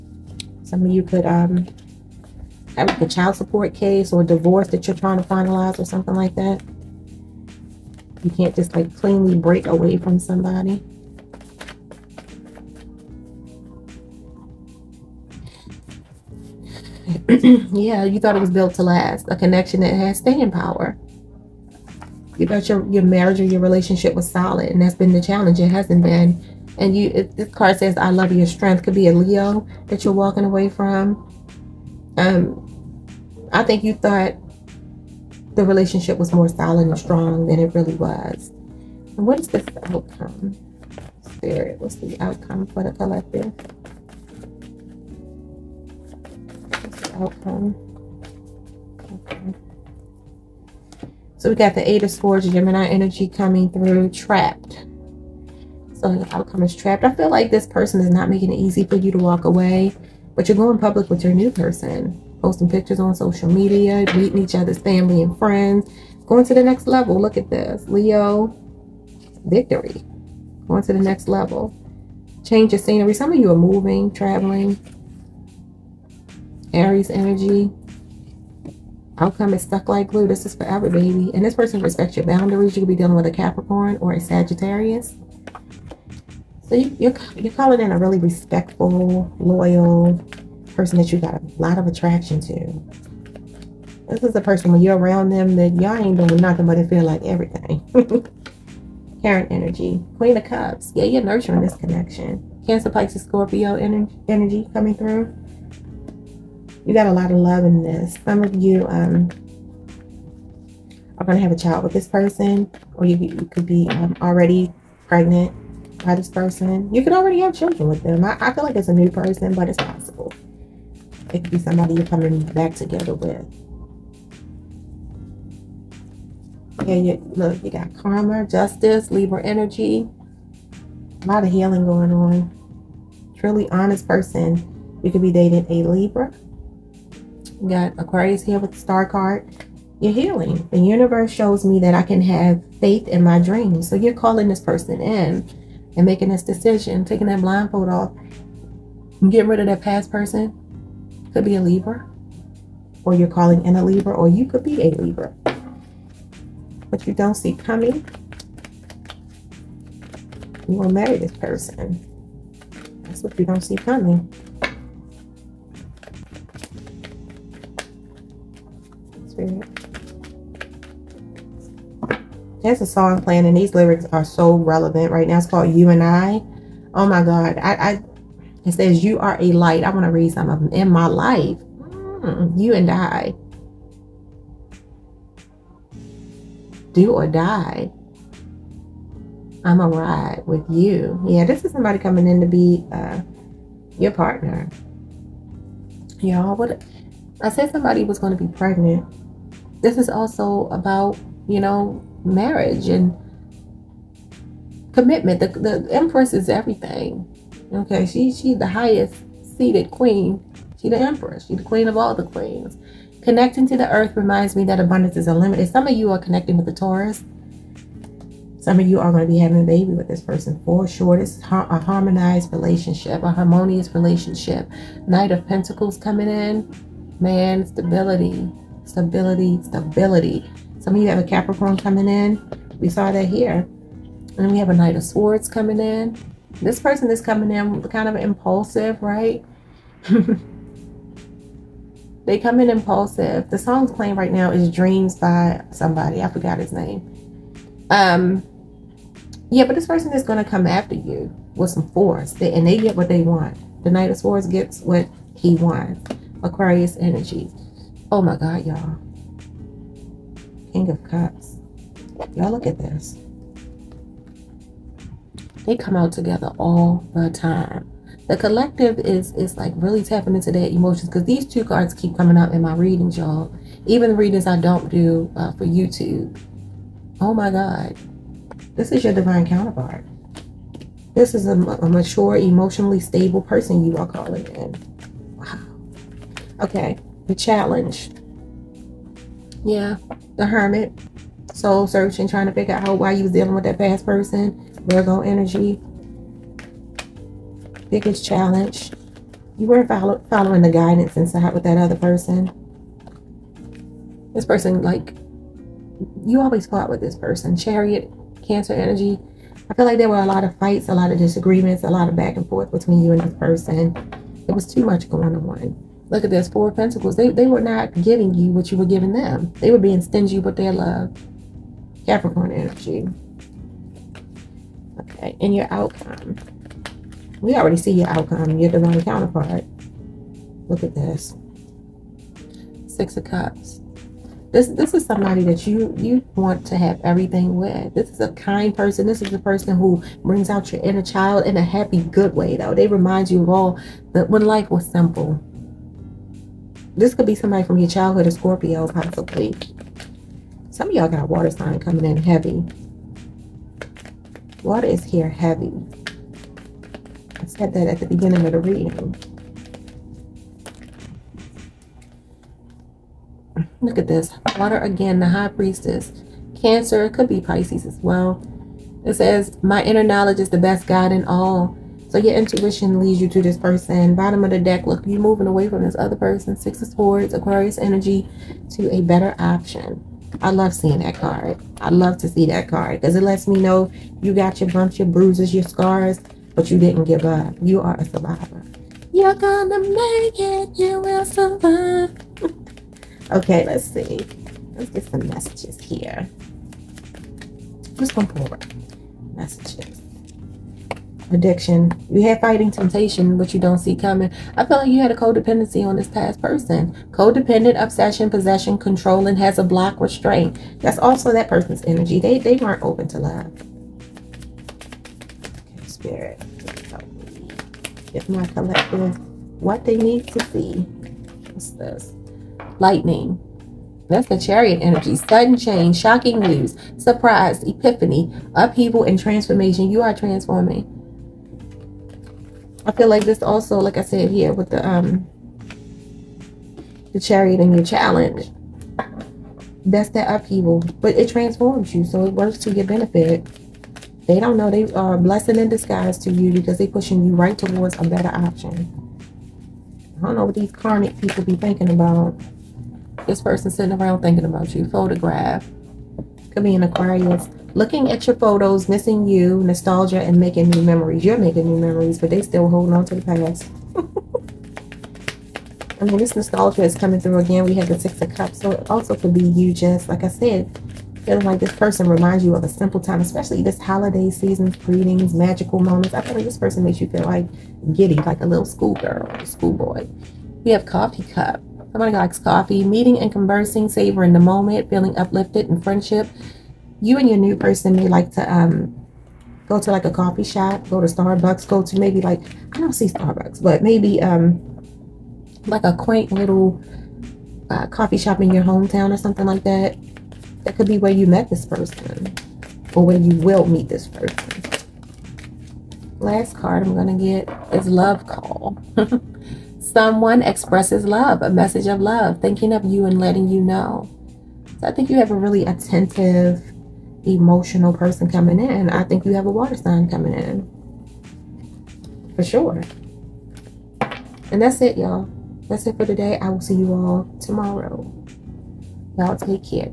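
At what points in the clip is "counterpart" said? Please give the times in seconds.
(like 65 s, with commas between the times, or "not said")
279 s, 329 s.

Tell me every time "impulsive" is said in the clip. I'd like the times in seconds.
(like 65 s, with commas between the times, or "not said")
238 s, 242 s.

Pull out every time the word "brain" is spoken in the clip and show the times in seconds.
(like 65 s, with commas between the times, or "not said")
not said.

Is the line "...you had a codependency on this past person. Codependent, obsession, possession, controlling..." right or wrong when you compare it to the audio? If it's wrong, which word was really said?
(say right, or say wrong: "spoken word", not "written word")
right.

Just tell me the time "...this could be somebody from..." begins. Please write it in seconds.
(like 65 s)
346 s.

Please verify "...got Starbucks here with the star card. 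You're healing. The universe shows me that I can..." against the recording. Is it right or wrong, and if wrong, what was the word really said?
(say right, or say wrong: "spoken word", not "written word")
wrong: "Aquarius", not "Starbucks".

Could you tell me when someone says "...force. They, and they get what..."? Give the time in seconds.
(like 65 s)
251 s.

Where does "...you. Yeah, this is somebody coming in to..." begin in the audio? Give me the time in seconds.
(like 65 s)
190 s.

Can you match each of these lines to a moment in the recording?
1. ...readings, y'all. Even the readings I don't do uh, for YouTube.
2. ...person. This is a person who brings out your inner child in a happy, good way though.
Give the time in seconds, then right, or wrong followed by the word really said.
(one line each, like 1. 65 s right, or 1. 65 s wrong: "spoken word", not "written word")
1. 272 s right
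2. 338 s right.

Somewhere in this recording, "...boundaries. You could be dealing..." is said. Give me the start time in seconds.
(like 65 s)
82 s.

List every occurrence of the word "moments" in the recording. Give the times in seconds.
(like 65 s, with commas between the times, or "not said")
475 s, 484 s.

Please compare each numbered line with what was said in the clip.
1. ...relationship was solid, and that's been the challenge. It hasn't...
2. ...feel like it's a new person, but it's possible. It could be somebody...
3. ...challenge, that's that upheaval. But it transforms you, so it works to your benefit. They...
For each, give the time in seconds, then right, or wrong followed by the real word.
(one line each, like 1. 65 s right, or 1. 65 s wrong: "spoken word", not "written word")
1. 23 s right
2. 118 s right
3. 437 s right.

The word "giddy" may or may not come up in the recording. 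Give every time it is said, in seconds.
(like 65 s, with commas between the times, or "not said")
477 s.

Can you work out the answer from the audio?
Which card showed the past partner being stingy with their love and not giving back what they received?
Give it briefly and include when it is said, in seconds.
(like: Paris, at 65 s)
Four of Pentacles, at 316 s.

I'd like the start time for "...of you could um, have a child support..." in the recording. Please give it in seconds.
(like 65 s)
0 s.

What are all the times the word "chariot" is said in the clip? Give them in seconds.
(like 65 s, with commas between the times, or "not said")
307 s, 424 s, 437 s.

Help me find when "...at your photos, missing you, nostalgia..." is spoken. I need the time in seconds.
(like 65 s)
458 s.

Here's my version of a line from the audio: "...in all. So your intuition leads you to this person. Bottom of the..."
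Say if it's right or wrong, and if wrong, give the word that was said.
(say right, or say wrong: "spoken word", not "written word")
right.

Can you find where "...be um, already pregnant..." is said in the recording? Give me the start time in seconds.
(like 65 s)
113 s.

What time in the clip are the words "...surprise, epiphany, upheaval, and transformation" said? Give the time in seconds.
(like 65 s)
426 s.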